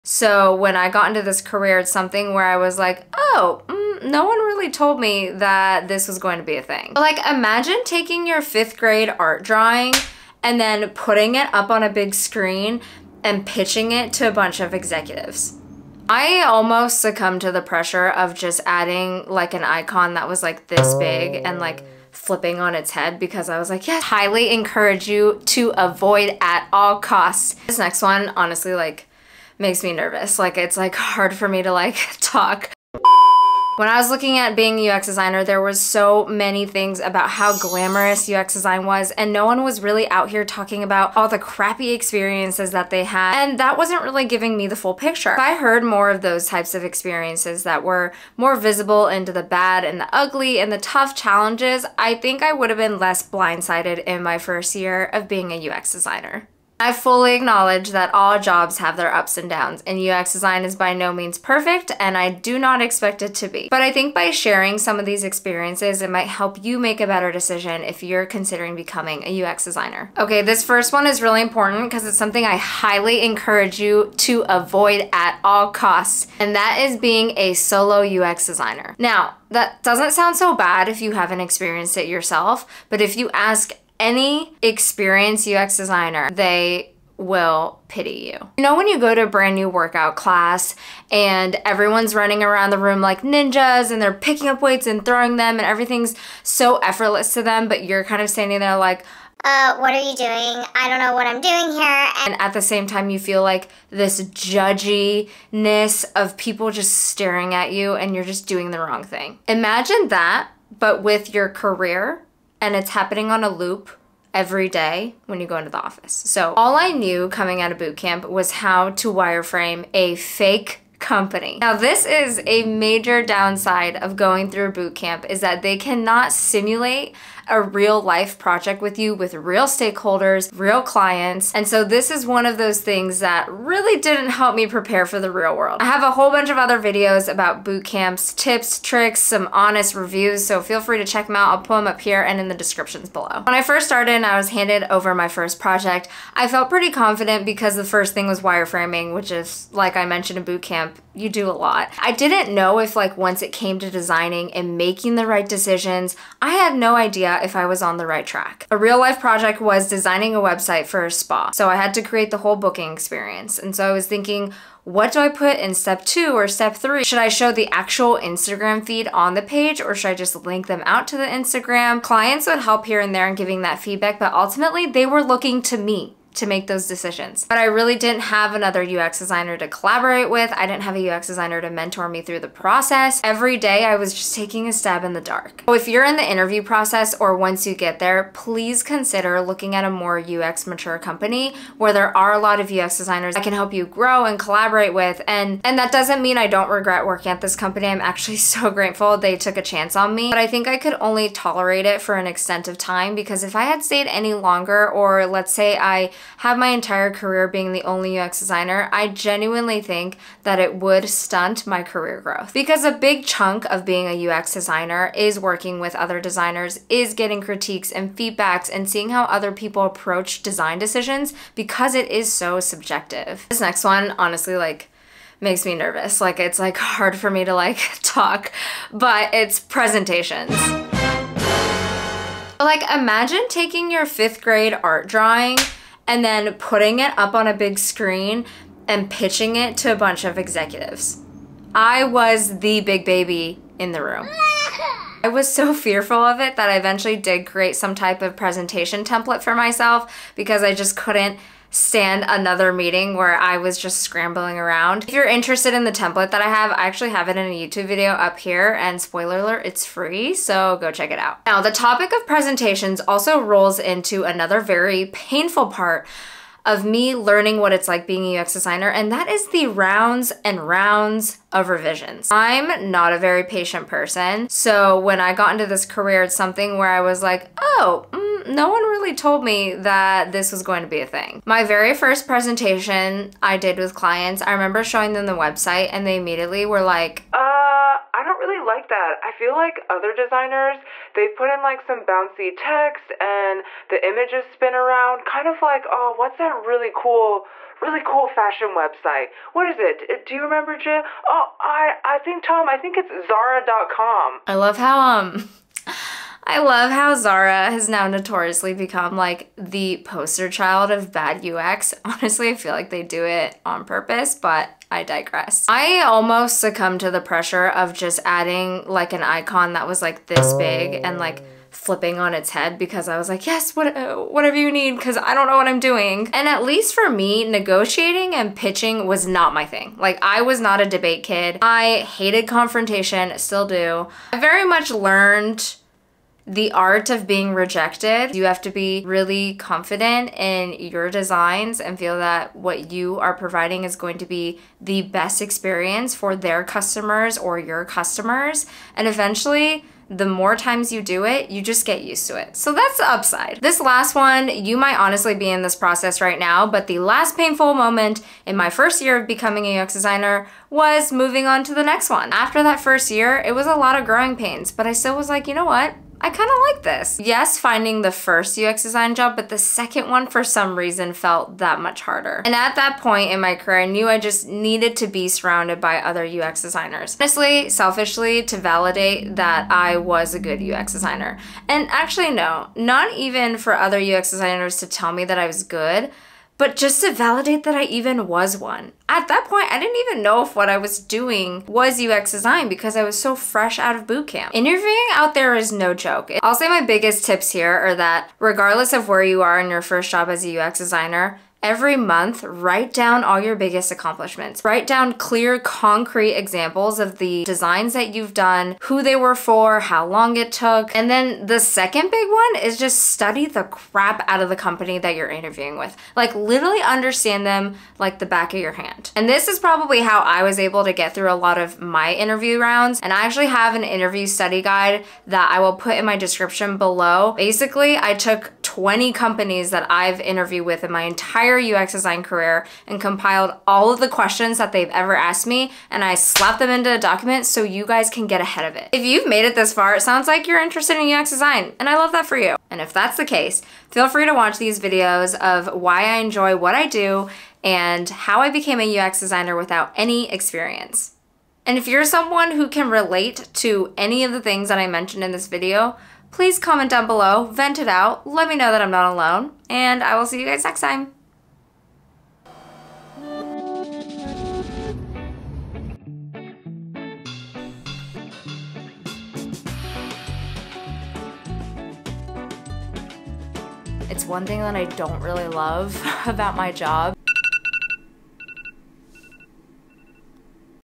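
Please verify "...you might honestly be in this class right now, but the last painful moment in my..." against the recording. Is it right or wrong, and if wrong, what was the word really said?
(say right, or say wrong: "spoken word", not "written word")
wrong: "process", not "class".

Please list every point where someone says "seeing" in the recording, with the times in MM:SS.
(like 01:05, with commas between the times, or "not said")
03:38.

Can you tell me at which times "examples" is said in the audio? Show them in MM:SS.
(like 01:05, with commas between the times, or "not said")
06:46.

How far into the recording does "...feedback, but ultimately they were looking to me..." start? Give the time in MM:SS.
02:53.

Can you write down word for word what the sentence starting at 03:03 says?
Every day I was just taking a stab in the dark.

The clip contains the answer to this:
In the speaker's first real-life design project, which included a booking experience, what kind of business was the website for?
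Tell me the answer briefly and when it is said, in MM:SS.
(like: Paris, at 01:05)
A spa, at 02:41.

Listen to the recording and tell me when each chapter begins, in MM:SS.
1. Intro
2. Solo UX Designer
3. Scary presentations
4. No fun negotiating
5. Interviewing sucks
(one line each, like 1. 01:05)
1. 00:30
2. 01:04
3. 03:44
4. 04:21
5. 05:57.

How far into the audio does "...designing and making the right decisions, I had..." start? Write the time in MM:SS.
02:33.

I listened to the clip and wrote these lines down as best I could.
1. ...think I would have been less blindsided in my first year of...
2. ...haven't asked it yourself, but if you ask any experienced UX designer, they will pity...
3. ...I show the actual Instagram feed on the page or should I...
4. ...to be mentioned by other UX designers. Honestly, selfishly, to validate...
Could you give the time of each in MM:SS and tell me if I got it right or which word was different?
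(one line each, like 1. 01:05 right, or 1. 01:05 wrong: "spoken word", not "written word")
1. 00:52 right
2. 01:21 wrong: "experienced", not "asked"
3. 02:47 right
4. 06:14 wrong: "surrounded", not "mentioned".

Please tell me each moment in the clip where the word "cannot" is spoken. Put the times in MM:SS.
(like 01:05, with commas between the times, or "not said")
02:05.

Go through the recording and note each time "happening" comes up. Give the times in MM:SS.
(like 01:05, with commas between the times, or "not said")
01:52.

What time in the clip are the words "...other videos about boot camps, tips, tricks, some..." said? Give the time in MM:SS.
02:16.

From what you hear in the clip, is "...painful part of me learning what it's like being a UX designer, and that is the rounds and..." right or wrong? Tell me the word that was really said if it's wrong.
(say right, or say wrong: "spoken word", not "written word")
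right.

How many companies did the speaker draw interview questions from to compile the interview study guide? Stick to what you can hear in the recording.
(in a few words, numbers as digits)
20.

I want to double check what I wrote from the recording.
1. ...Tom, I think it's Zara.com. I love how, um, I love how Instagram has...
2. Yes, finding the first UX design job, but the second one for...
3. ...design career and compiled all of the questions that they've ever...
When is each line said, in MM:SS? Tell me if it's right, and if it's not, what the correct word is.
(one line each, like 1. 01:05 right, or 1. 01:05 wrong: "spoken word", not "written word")
1. 05:02 wrong: "Zara", not "Instagram"
2. 06:07 right
3. 07:11 right.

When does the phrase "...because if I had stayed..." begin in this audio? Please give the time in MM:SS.
03:23.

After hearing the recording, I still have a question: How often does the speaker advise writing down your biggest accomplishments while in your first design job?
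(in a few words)
Every month.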